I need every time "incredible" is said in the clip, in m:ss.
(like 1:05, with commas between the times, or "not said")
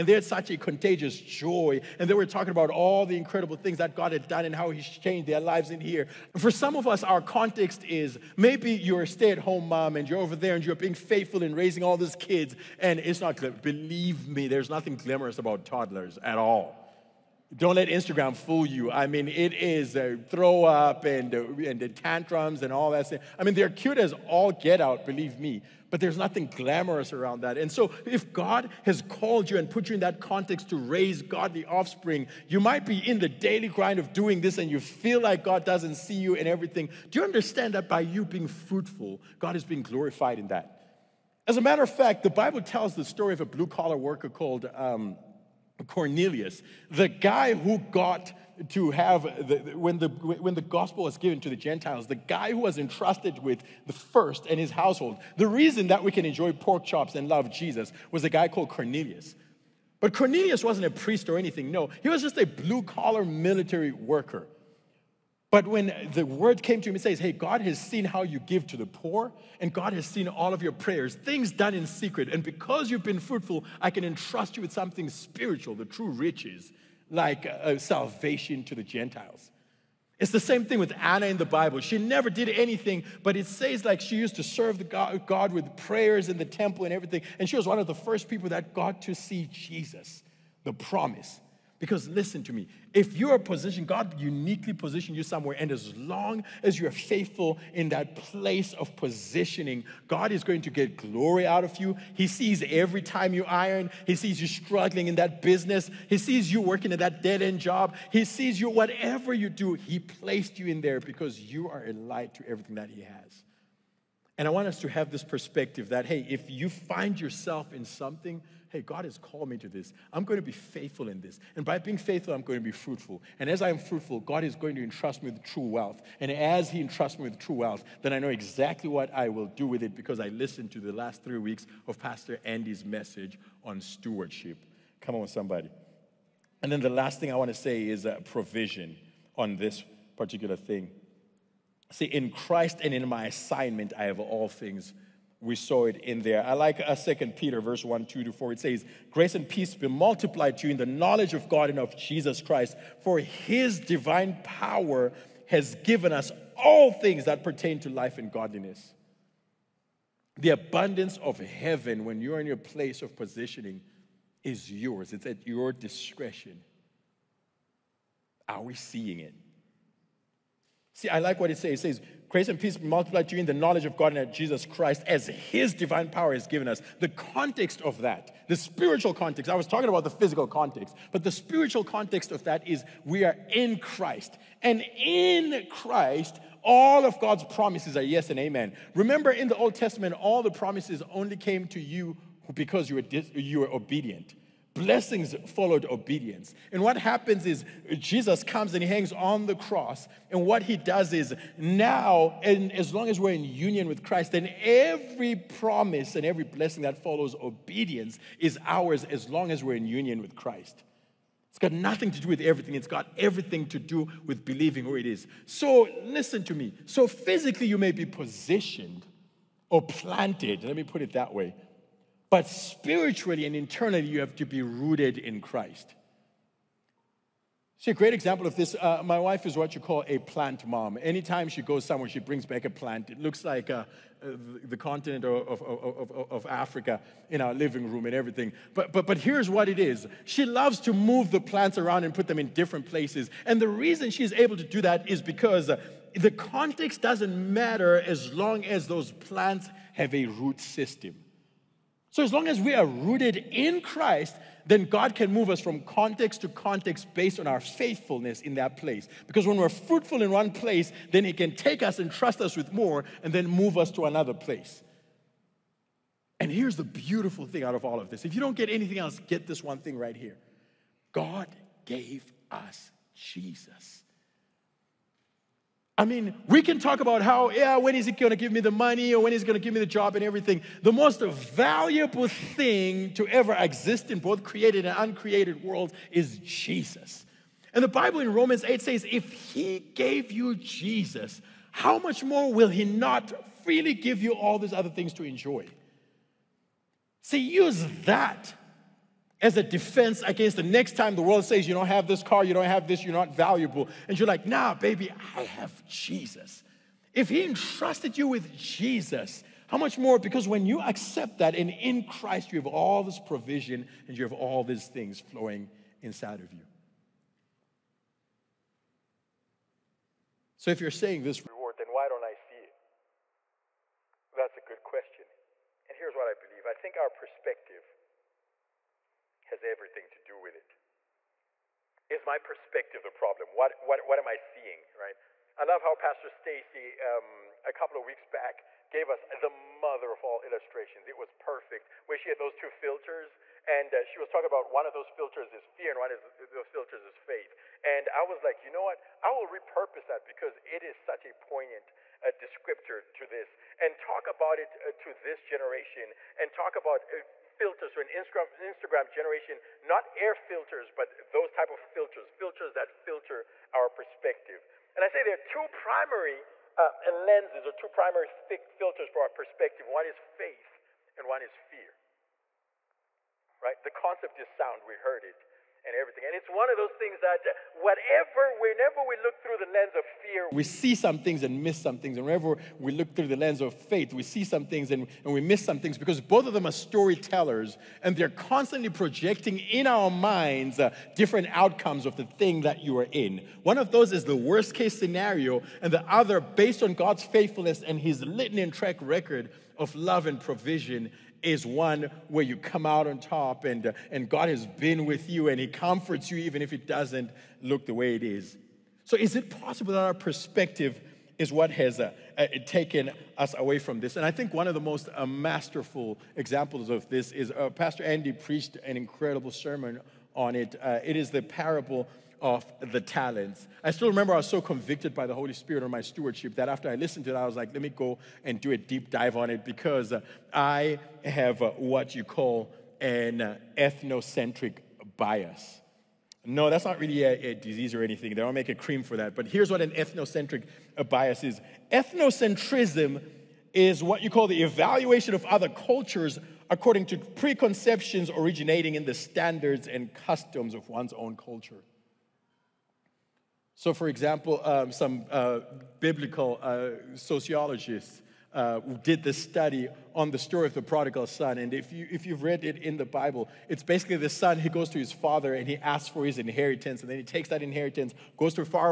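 0:03, 6:58.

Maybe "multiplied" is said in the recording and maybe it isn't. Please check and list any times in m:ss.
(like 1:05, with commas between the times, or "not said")
2:29, 2:52.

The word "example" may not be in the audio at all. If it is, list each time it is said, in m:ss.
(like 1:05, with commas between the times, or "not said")
3:48, 6:56, 7:34.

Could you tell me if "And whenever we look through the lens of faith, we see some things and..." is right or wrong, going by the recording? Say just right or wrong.
right.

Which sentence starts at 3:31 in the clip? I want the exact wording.
It's got nothing to do with everything.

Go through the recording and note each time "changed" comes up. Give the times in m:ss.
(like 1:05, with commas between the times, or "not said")
0:04.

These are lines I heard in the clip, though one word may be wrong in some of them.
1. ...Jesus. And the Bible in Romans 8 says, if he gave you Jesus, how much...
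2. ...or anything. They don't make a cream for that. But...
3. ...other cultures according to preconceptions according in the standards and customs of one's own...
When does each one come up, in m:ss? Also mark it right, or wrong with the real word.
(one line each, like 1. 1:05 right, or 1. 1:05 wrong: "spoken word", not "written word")
1. 4:46 right
2. 7:17 right
3. 7:25 wrong: "originating", not "according".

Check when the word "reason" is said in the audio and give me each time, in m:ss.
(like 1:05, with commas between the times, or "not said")
0:55, 4:03.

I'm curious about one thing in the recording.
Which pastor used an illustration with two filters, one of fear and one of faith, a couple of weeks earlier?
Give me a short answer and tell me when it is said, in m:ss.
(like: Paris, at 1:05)
Pastor Stacy, at 5:35.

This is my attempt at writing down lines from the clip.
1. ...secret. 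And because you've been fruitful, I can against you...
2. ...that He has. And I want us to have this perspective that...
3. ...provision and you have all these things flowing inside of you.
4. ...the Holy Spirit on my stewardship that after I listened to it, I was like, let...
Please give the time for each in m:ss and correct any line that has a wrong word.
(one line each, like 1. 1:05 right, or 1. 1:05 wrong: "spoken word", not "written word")
1. 1:11 wrong: "entrust", not "against"
2. 1:52 right
3. 5:13 right
4. 7:05 right.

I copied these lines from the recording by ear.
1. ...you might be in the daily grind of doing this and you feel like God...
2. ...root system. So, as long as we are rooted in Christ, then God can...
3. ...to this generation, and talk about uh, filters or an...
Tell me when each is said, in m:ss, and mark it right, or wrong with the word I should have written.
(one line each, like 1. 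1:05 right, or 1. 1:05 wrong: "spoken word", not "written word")
1. 0:32 right
2. 4:10 right
3. 5:54 right.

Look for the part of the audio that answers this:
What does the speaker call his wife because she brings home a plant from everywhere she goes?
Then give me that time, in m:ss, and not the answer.
3:50.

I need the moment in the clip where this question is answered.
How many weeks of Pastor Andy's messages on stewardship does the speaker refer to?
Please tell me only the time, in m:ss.
2:11.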